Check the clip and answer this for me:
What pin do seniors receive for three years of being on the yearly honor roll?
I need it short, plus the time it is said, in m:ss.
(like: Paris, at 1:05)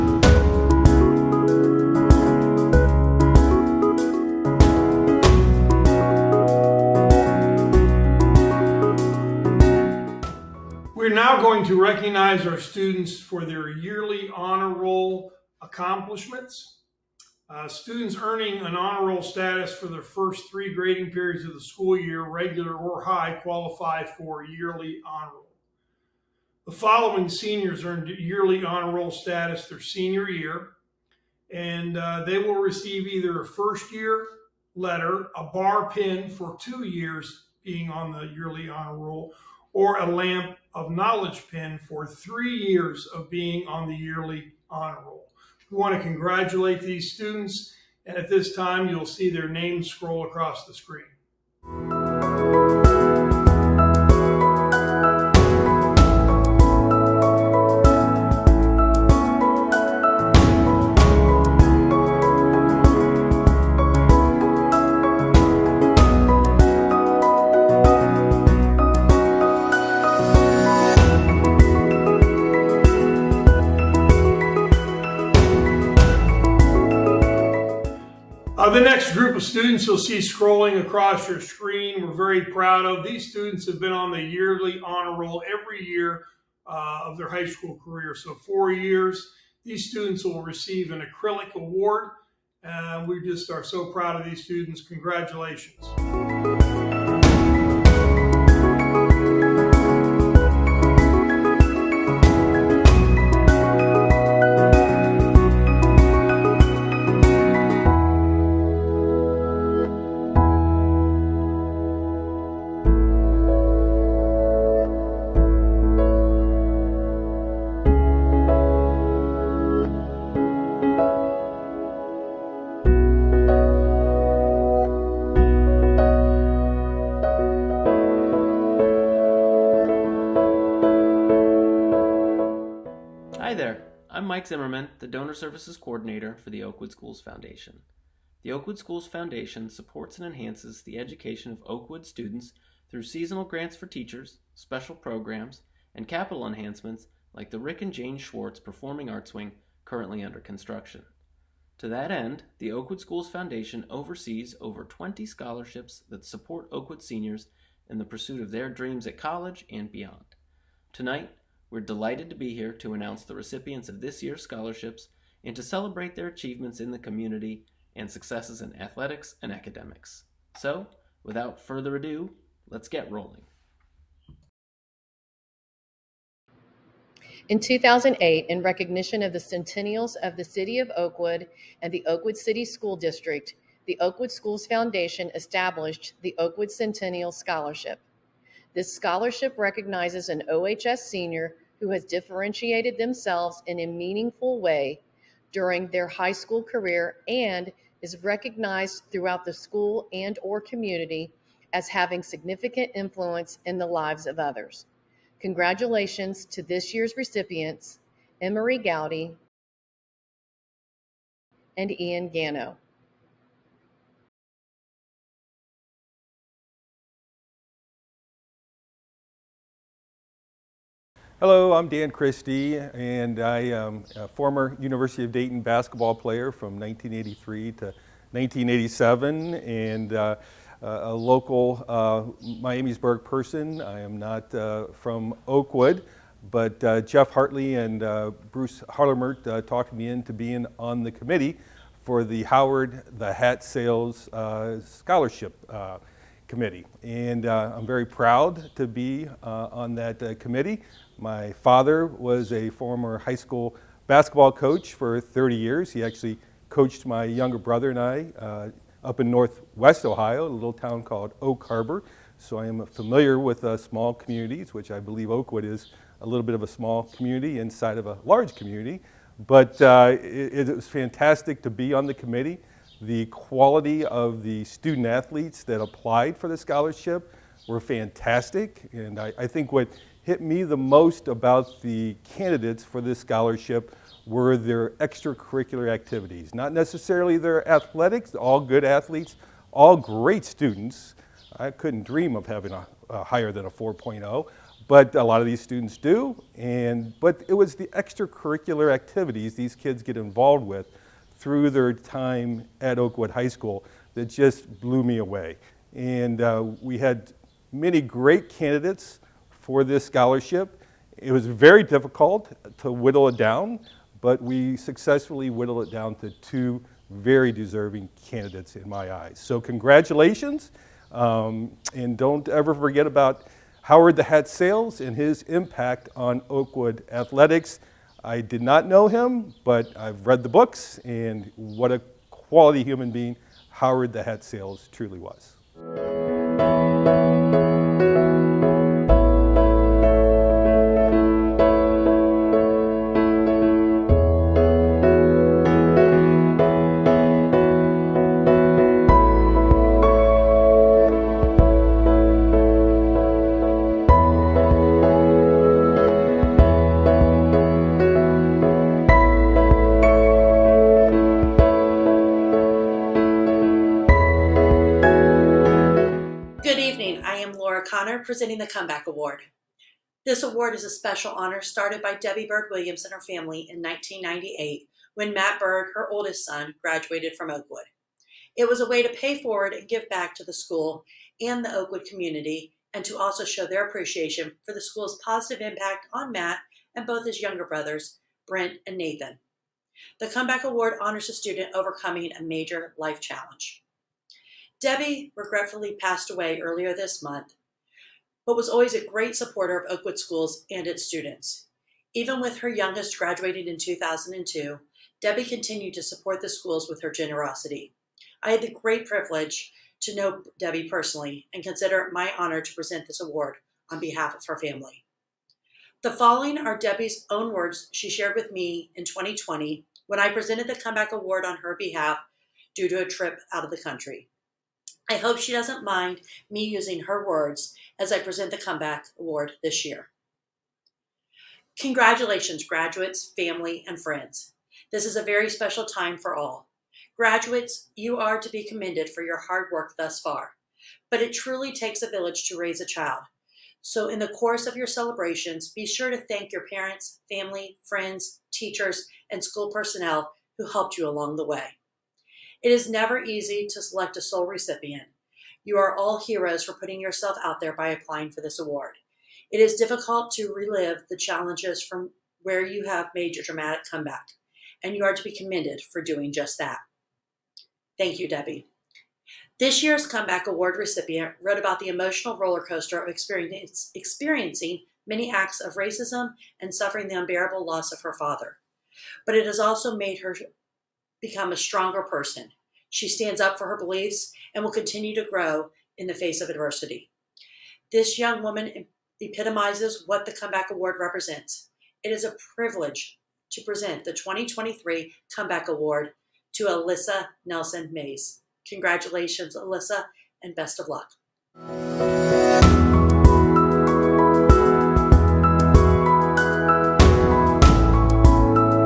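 Lamp of knowledge pin, at 0:40.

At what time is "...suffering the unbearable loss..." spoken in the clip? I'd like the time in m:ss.
7:56.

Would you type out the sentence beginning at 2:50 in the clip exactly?
So, without further ado, let's get rolling.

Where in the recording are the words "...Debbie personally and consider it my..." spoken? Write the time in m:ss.
6:50.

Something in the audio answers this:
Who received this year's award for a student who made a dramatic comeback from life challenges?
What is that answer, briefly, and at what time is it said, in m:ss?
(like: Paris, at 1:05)
Alyssa Nelson Mays, at 8:16.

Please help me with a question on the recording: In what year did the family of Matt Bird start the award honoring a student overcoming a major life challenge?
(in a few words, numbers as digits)
1998.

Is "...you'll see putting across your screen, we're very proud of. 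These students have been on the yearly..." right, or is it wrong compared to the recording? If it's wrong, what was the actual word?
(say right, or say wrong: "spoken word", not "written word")
wrong: "scrolling", not "putting".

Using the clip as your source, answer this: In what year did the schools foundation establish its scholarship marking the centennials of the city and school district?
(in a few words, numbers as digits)
2008.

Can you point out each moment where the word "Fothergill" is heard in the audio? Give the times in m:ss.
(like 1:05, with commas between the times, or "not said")
not said.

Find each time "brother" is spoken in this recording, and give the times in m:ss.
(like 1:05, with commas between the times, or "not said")
4:17, 6:27.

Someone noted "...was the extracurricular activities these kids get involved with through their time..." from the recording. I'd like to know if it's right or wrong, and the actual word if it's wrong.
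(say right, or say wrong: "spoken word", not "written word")
right.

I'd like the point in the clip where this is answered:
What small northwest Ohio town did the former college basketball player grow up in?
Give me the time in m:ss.
4:21.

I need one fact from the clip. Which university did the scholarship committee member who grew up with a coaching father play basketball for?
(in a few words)
University of Dayton.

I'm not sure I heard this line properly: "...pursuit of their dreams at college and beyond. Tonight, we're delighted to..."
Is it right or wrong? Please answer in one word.
right.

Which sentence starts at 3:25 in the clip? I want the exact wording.
Congratulations to this year's recipients, Emery Gowdy and Ian Gano.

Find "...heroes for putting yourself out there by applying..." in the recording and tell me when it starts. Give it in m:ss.
7:36.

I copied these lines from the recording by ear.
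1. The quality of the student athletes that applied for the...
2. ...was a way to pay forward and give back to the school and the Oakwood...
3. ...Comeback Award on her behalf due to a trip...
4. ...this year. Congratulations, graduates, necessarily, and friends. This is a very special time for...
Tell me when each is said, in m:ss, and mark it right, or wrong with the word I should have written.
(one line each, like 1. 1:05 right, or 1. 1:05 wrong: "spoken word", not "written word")
1. 4:32 right
2. 6:18 right
3. 7:00 right
4. 7:09 wrong: "family", not "necessarily".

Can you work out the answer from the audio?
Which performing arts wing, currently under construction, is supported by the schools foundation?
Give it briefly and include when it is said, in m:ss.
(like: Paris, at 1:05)
Rick and Jane Schwartz Performing Arts Wing, at 2:27.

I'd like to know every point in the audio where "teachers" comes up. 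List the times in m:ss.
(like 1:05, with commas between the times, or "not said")
2:23, 7:28.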